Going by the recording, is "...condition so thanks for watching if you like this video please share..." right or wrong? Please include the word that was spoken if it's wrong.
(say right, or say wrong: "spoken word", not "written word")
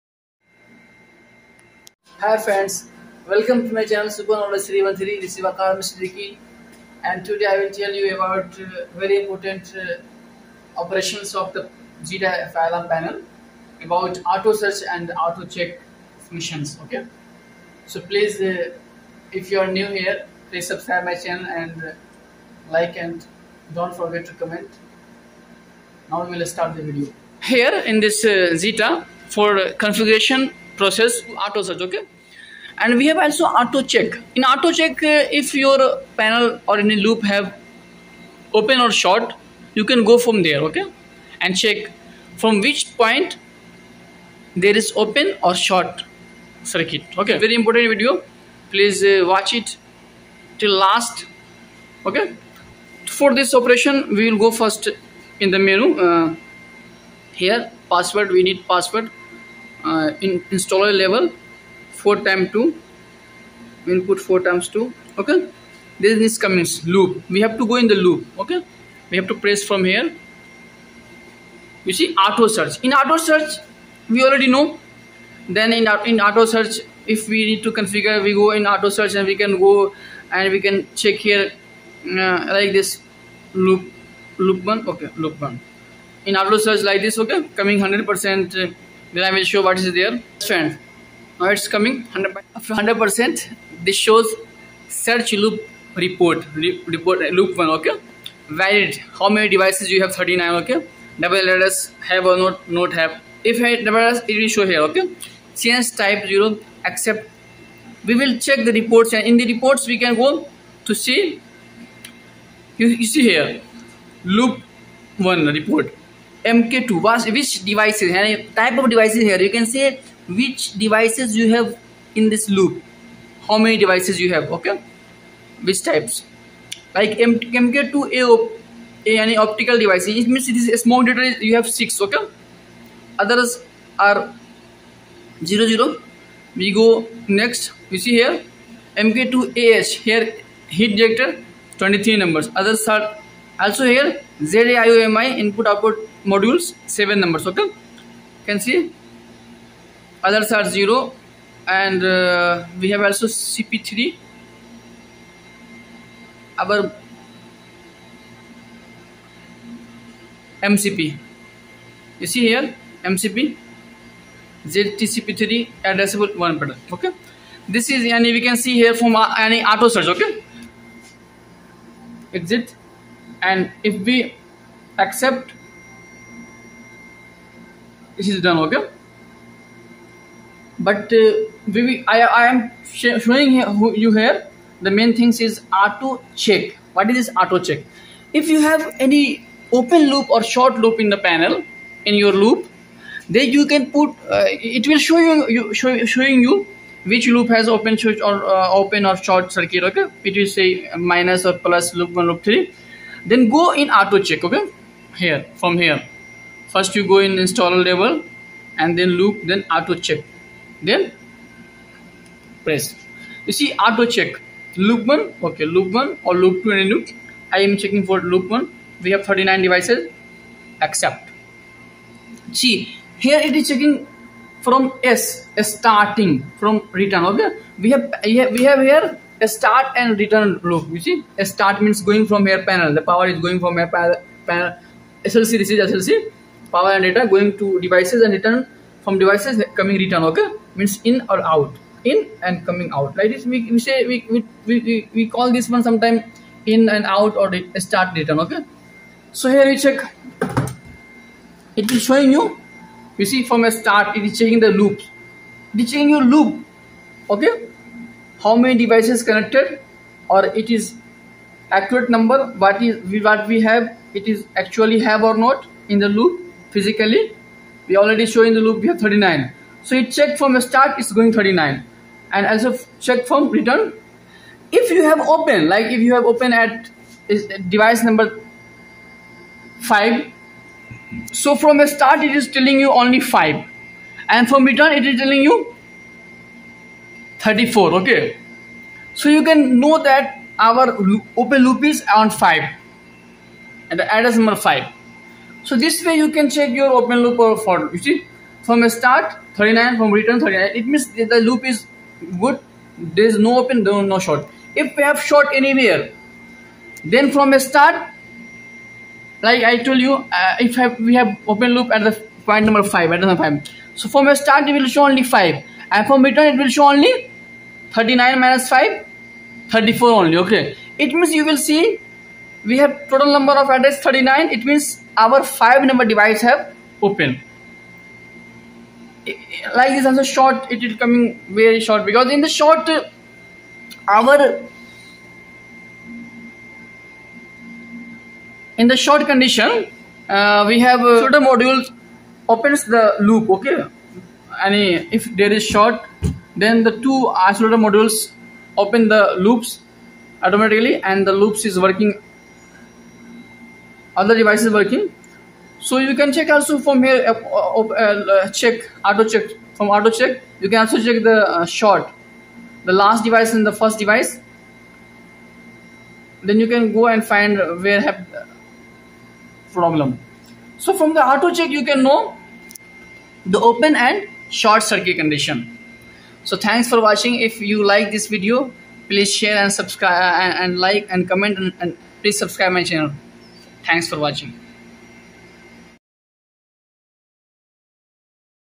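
right.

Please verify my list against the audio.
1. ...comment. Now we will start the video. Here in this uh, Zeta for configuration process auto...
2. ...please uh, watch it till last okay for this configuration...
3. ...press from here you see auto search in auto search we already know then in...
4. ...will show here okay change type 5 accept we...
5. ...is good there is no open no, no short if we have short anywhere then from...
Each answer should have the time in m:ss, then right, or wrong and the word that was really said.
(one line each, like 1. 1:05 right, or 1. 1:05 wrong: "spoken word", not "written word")
1. 0:24 right
2. 0:48 wrong: "operation", not "configuration"
3. 1:09 right
4. 1:44 wrong: "0", not "5"
5. 5:01 right.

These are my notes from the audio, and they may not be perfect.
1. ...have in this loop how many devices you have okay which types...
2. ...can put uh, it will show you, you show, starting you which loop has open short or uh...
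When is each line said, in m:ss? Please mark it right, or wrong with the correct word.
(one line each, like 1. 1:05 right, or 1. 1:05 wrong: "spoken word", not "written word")
1. 2:01 right
2. 3:13 wrong: "showing", not "starting".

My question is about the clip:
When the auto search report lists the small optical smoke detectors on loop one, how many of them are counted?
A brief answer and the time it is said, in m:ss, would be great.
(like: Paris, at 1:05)
6, at 2:11.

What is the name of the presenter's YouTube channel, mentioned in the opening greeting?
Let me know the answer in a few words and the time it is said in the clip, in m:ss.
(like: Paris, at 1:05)
Super Knowledge 313, at 0:04.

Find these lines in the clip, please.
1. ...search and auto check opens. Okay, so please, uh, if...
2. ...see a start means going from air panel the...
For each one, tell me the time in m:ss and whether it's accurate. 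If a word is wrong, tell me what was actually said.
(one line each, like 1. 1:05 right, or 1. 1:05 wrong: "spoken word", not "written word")
1. 0:14 wrong: "missions", not "opens"
2. 3:51 right.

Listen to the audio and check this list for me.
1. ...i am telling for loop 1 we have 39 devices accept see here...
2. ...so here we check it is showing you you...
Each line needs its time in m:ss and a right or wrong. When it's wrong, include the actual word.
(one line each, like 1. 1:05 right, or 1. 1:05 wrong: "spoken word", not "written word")
1. 3:37 wrong: "checking", not "telling"
2. 4:09 right.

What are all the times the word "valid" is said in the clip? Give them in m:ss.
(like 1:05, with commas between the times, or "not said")
1:38.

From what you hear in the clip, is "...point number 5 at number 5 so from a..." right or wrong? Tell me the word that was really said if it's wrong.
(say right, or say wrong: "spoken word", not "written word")
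right.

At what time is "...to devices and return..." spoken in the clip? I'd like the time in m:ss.
3:57.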